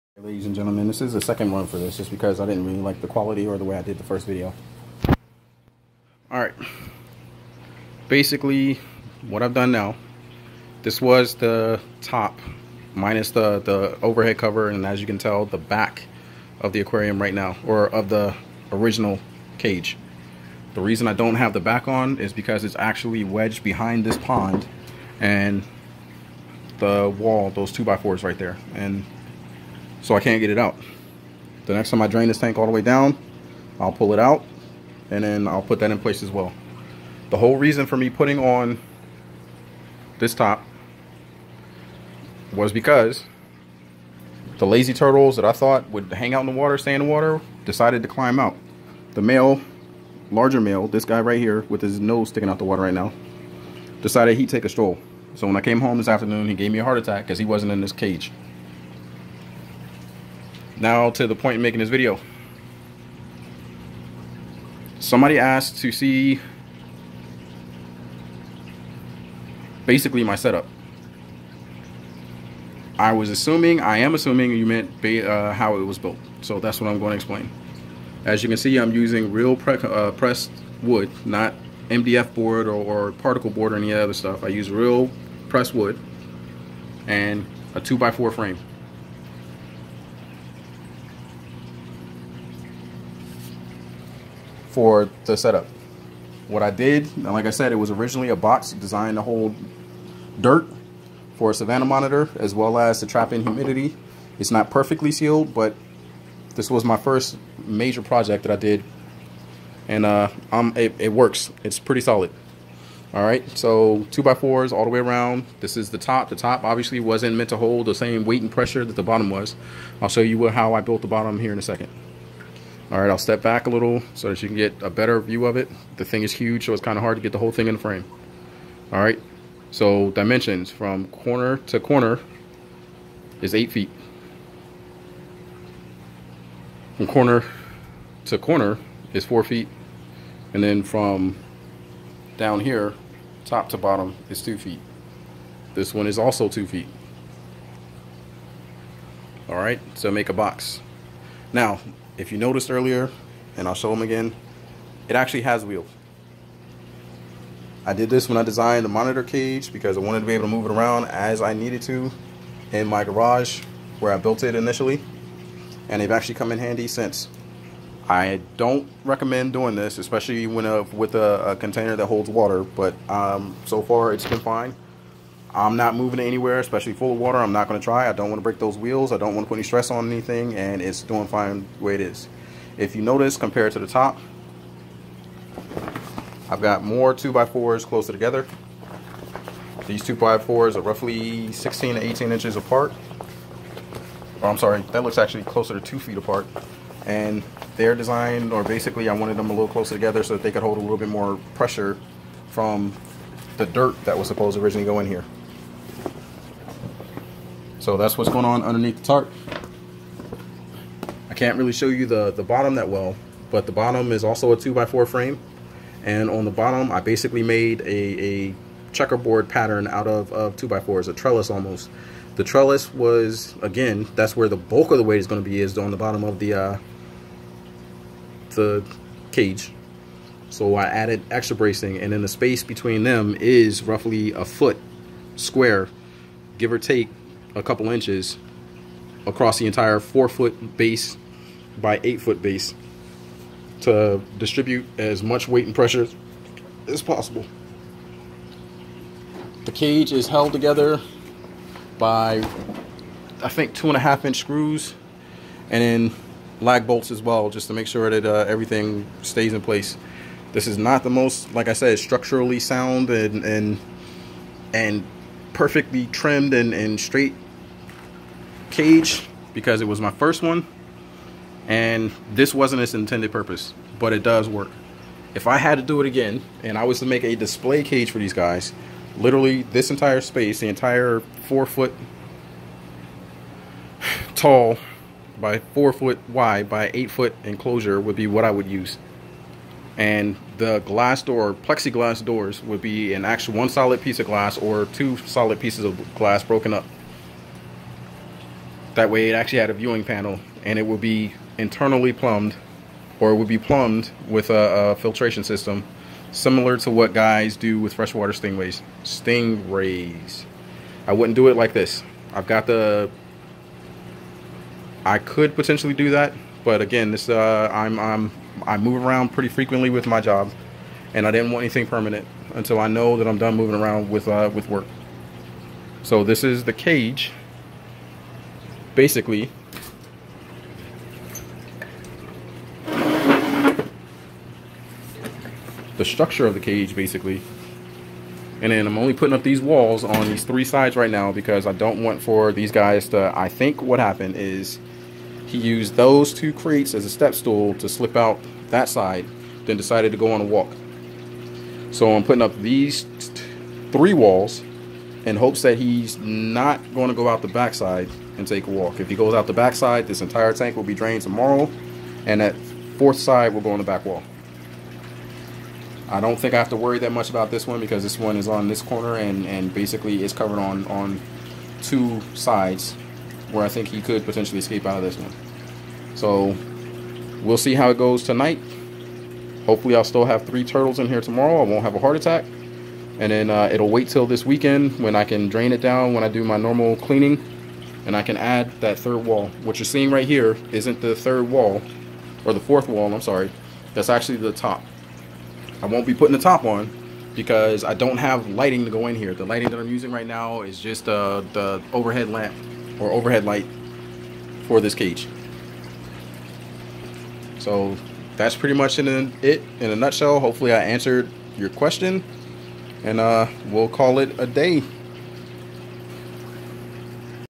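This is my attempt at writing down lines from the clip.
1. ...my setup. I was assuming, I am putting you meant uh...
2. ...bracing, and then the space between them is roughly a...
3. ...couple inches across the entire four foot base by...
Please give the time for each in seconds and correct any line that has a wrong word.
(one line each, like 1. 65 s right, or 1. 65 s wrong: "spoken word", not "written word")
1. 70 s wrong: "assuming", not "putting"
2. 231 s right
3. 237 s right.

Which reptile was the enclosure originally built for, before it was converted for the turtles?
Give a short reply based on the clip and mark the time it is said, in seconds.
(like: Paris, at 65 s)
Savannah monitor, at 101 s.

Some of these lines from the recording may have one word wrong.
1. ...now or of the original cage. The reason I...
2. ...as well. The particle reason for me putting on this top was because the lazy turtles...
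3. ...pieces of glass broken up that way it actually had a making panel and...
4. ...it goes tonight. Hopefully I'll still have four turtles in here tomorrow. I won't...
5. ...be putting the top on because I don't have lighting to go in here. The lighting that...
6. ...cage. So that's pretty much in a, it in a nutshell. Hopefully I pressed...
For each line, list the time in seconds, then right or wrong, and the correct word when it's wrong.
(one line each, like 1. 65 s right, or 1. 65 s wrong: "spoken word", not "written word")
1. 17 s right
2. 36 s wrong: "whole", not "particle"
3. 295 s wrong: "viewing", not "making"
4. 377 s wrong: "three", not "four"
5. 396 s right
6. 404 s wrong: "answered", not "pressed".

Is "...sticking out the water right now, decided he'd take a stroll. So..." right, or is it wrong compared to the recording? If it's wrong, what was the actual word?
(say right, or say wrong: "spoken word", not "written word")
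right.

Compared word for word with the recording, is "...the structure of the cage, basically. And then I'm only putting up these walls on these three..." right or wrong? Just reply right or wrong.
right.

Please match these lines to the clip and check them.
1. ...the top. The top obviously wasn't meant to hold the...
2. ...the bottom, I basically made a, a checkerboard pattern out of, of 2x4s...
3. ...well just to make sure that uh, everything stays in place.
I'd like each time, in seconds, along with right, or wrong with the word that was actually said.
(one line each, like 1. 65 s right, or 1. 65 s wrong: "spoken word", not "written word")
1. 115 s right
2. 216 s right
3. 257 s right.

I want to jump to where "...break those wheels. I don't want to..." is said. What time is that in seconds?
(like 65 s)
178 s.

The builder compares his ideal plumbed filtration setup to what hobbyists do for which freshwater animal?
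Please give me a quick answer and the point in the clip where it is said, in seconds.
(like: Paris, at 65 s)
Stingrays, at 307 s.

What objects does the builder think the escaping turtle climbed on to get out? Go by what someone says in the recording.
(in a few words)
Two crates.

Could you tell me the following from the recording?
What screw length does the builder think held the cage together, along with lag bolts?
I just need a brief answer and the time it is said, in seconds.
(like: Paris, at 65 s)
2.5 inch, at 253 s.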